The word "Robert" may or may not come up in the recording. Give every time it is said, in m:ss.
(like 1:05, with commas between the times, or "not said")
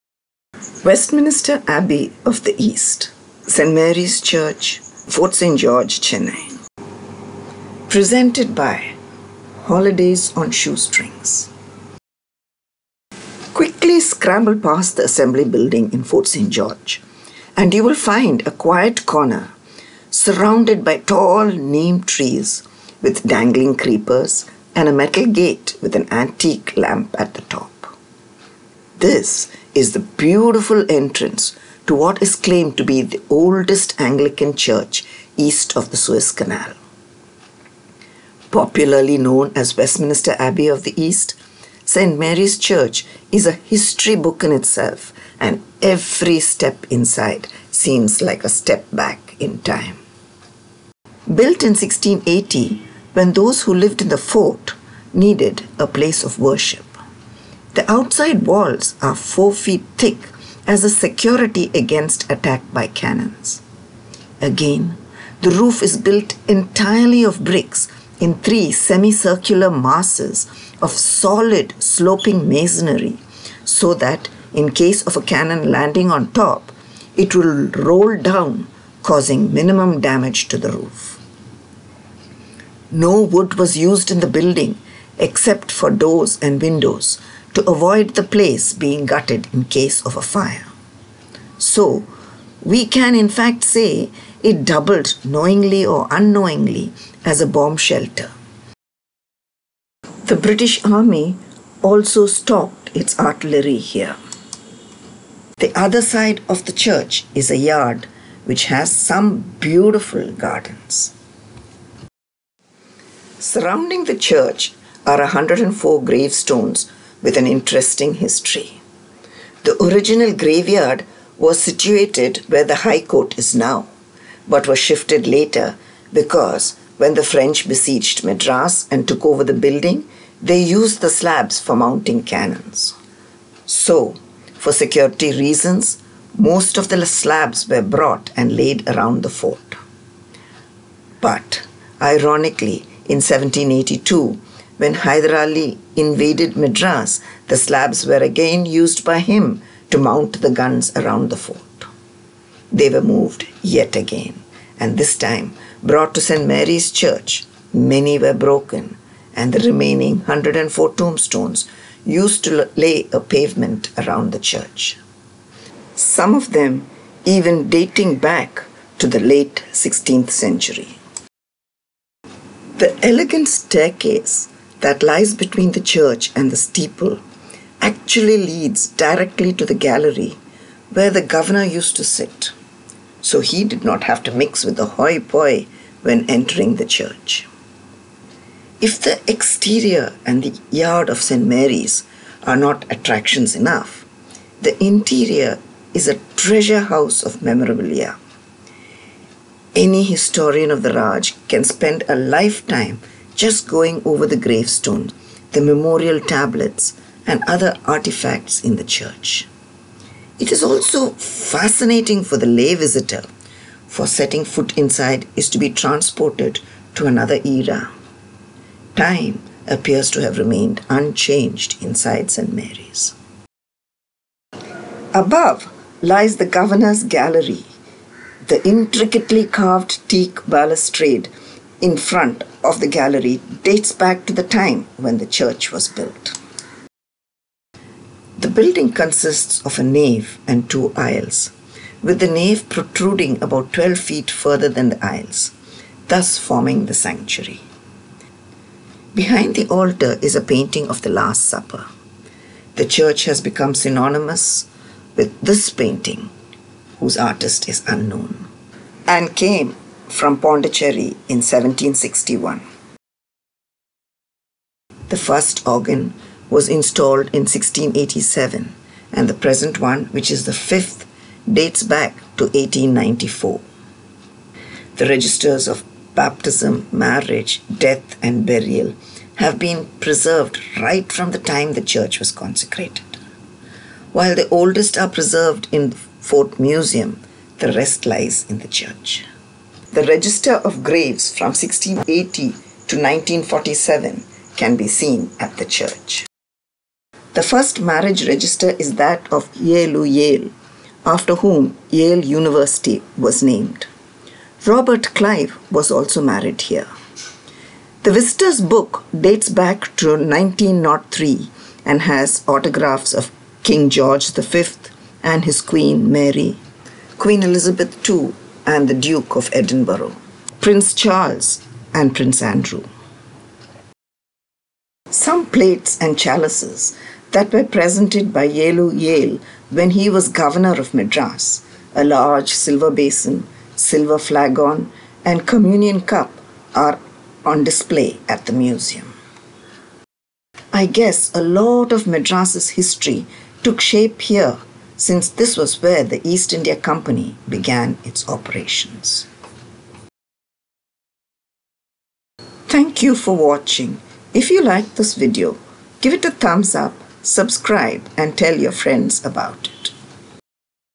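5:04.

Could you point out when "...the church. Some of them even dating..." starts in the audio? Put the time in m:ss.
2:44.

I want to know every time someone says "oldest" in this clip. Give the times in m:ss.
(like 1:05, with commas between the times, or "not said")
0:33, 4:44.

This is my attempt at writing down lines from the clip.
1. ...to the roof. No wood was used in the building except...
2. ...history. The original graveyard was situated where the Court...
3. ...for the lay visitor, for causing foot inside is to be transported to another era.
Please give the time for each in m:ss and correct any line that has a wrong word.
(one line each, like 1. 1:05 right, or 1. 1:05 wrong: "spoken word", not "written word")
1. 1:20 right
2. 1:58 wrong: "High", not "Court"
3. 3:32 wrong: "setting", not "causing".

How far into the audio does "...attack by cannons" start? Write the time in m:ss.
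1:02.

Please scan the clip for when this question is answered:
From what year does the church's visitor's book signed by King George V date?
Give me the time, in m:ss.
5:10.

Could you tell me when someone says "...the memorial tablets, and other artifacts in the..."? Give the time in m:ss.
3:25.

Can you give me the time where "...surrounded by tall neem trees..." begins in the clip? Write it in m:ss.
0:20.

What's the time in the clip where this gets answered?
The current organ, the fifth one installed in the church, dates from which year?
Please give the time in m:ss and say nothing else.
4:32.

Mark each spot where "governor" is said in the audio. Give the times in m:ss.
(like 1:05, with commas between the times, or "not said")
3:01, 3:46, 5:30.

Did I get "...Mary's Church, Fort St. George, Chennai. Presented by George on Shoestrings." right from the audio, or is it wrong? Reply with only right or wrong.
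wrong.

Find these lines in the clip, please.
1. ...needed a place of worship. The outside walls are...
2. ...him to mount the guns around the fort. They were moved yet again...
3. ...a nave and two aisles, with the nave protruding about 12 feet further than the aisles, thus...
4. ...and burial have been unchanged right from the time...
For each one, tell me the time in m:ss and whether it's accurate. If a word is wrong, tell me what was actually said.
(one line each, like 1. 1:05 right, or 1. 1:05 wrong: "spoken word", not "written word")
1. 0:55 right
2. 2:29 right
3. 3:59 right
4. 4:38 wrong: "preserved", not "unchanged".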